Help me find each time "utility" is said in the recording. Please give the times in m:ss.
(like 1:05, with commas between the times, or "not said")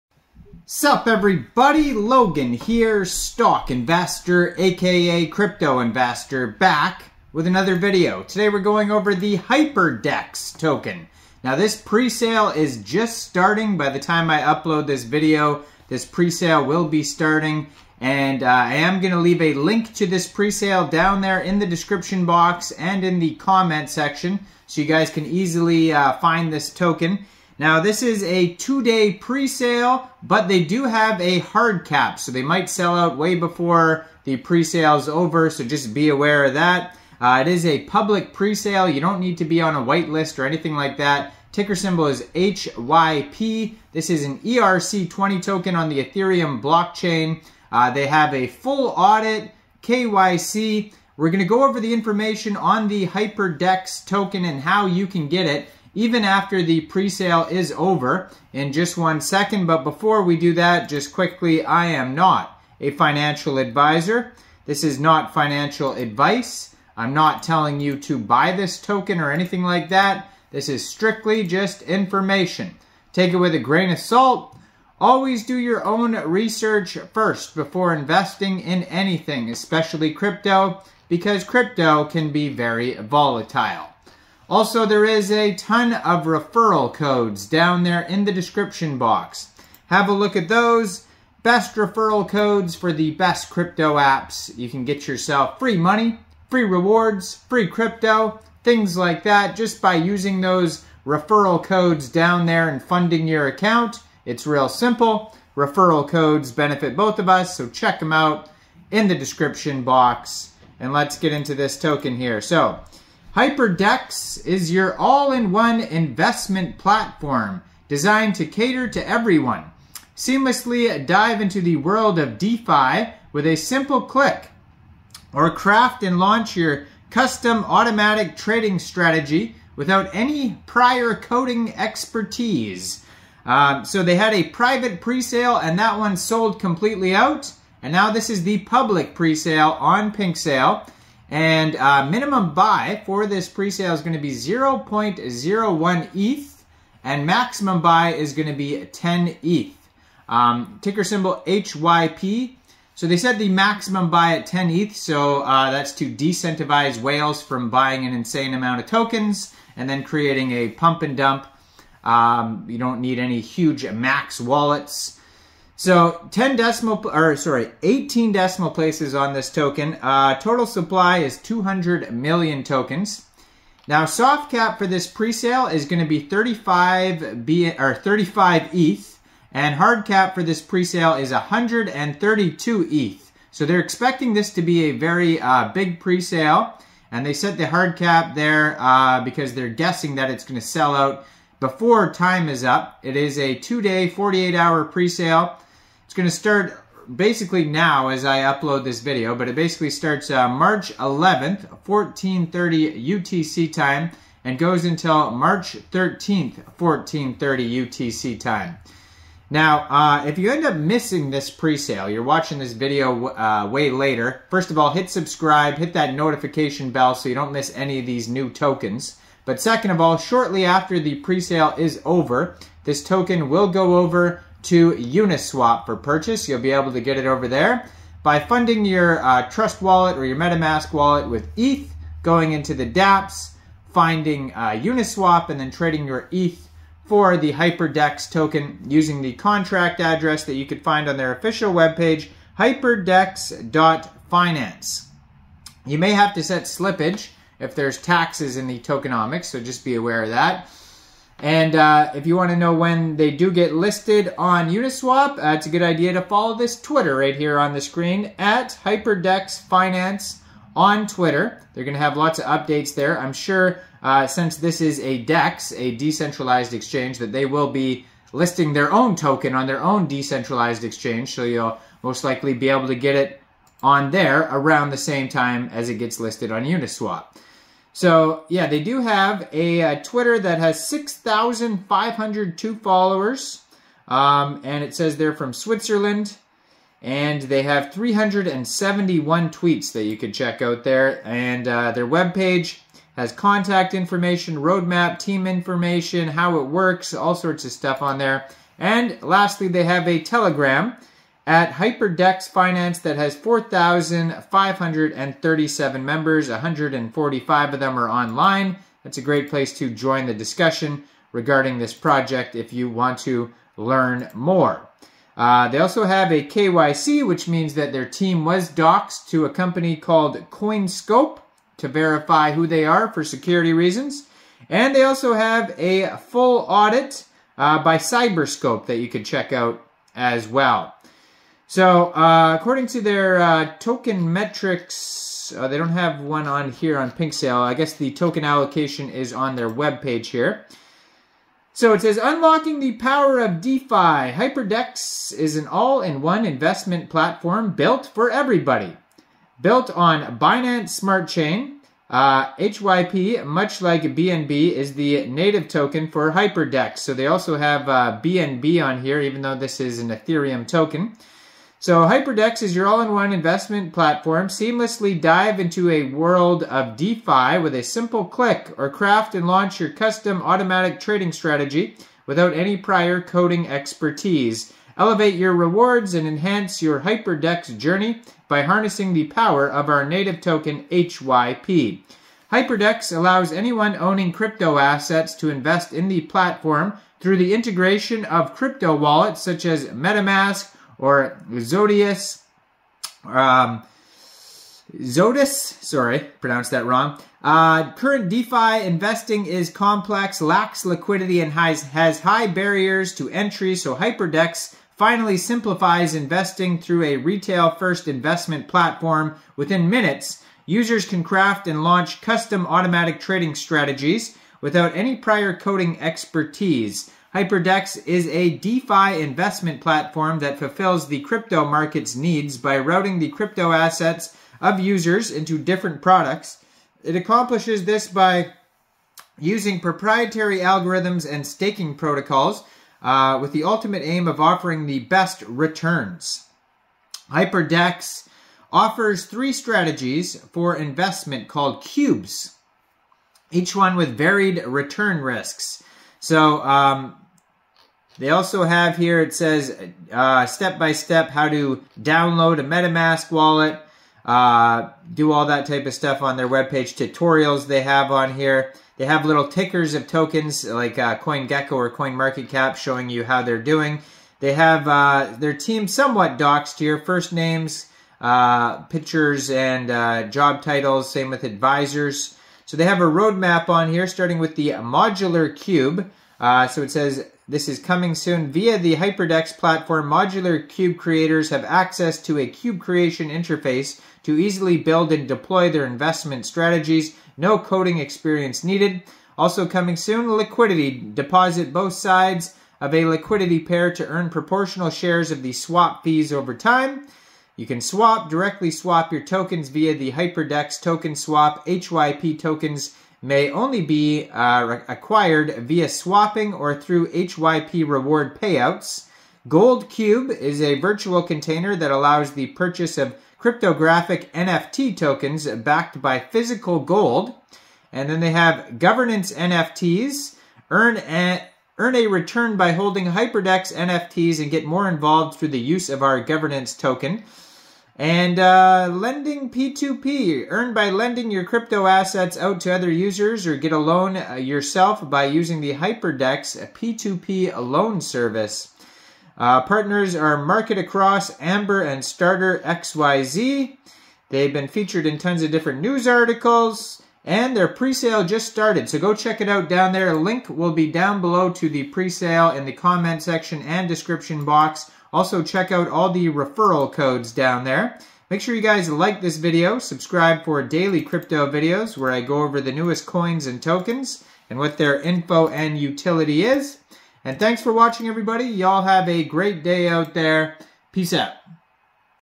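9:25.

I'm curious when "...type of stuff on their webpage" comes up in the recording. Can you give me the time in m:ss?
7:35.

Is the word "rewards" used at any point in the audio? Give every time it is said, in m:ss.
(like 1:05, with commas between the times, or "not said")
1:36, 6:15, 8:27.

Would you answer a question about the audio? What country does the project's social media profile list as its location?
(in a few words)
Switzerland.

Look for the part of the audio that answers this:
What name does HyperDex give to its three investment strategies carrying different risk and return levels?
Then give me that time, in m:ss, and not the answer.
7:21.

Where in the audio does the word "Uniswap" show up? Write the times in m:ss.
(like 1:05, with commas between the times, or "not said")
3:44, 3:54, 4:14, 4:36.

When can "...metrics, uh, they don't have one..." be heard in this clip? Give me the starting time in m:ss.
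5:34.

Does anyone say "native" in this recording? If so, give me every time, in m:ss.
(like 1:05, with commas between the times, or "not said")
5:55, 6:20.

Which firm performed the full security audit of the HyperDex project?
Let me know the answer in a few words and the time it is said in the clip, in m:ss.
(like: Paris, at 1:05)
Cyberscope, at 5:27.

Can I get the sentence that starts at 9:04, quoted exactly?
They've been featured in tons of different news articles, and their pre sale just started.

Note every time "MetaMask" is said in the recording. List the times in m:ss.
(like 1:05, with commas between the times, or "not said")
3:50, 6:29, 7:32.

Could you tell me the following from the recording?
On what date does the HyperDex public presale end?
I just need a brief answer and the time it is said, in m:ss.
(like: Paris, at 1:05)
March 13th, at 3:25.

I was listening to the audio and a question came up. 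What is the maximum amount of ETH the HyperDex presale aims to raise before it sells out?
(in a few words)
132 ETH.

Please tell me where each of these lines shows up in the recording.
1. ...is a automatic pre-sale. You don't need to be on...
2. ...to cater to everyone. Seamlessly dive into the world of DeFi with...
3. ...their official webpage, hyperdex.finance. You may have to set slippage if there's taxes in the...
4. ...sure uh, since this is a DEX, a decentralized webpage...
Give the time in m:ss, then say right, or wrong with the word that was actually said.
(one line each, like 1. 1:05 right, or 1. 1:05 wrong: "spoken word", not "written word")
1. 0:37 wrong: "public", not "automatic"
2. 1:58 right
3. 4:01 right
4. 4:23 wrong: "exchange", not "webpage".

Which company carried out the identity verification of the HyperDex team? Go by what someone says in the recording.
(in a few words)
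CoinScope.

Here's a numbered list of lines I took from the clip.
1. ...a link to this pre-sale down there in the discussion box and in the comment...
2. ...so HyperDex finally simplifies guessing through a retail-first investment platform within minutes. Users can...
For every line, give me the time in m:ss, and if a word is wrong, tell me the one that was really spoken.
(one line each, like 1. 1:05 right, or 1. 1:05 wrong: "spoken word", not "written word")
1. 0:19 wrong: "description", not "discussion"
2. 6:43 wrong: "investing", not "guessing".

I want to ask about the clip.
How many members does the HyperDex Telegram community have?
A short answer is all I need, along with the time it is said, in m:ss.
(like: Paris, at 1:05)
4,537, at 5:03.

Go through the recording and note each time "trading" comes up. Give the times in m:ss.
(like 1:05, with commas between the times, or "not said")
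2:08, 3:55, 6:10, 6:53.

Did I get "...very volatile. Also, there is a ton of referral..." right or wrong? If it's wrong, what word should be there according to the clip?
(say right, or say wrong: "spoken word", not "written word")
right.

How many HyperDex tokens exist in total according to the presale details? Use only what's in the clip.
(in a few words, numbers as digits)
200 million.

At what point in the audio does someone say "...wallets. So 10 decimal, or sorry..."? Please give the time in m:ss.
2:44.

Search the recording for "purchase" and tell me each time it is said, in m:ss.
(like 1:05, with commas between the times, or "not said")
3:45, 8:32.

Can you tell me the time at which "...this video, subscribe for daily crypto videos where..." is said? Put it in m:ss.
9:19.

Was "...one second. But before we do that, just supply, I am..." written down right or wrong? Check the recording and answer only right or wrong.
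wrong.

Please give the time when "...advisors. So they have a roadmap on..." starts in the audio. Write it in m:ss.
7:51.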